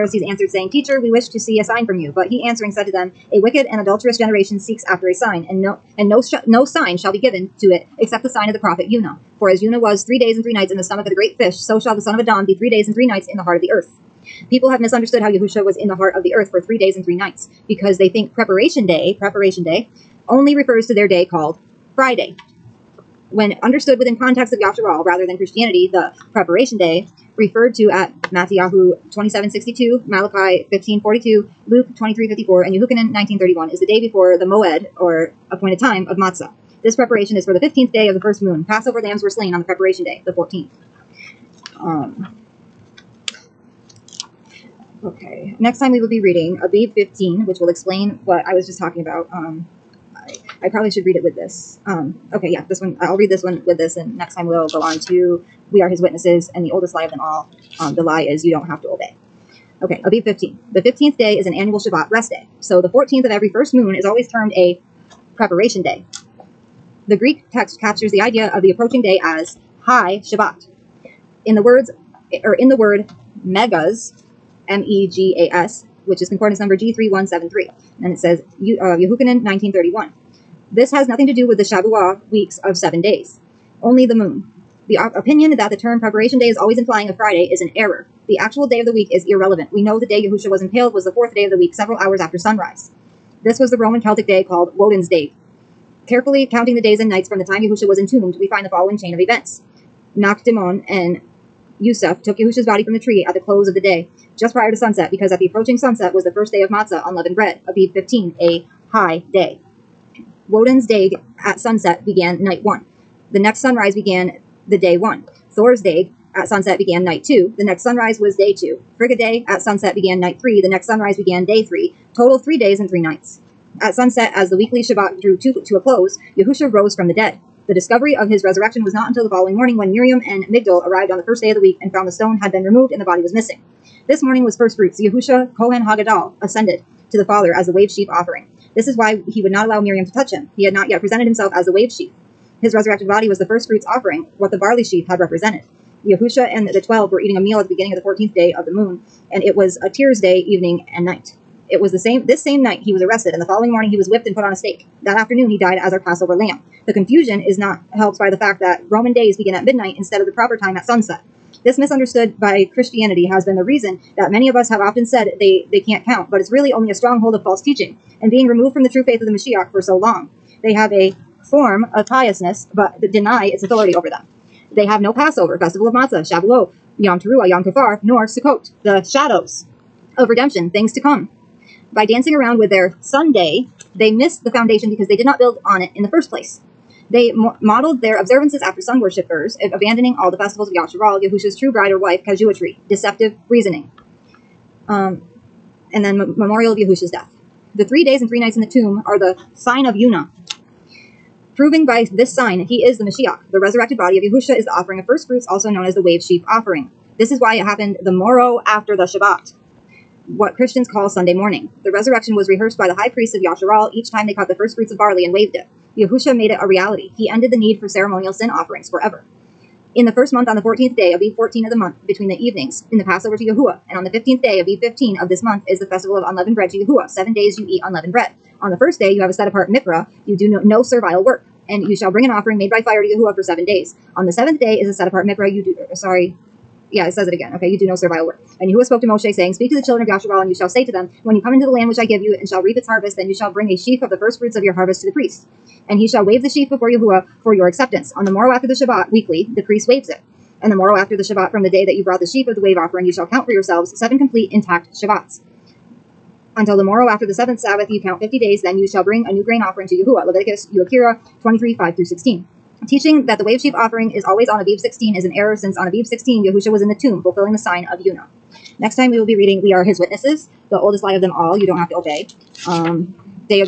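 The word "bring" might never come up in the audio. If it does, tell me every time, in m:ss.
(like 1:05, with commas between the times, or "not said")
3:52, 4:03, 4:19.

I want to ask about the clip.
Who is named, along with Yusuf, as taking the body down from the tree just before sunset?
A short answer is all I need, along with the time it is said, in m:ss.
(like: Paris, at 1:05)
Nakdimon, at 1:40.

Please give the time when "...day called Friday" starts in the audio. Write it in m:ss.
0:21.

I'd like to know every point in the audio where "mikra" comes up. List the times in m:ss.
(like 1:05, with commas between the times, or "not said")
3:49, 3:55.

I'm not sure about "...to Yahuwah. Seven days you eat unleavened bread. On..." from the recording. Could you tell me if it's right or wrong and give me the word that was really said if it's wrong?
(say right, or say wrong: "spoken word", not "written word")
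right.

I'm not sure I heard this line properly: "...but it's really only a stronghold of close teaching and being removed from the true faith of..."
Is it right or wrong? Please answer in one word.
wrong.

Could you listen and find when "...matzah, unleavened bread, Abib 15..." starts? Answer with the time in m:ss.
1:46.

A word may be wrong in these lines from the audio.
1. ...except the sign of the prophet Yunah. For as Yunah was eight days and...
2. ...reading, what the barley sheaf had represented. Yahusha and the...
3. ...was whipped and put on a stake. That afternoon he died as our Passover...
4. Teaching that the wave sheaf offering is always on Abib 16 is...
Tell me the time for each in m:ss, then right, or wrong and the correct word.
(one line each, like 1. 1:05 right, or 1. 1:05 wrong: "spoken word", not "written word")
1. 0:07 wrong: "three", not "eight"
2. 2:23 wrong: "offering", not "reading"
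3. 2:33 right
4. 4:22 right.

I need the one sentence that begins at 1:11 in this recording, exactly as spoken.
In the words or in the word megas, M E G A S, which is concordance number G3173.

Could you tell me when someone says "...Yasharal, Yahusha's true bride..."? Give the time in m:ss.
3:10.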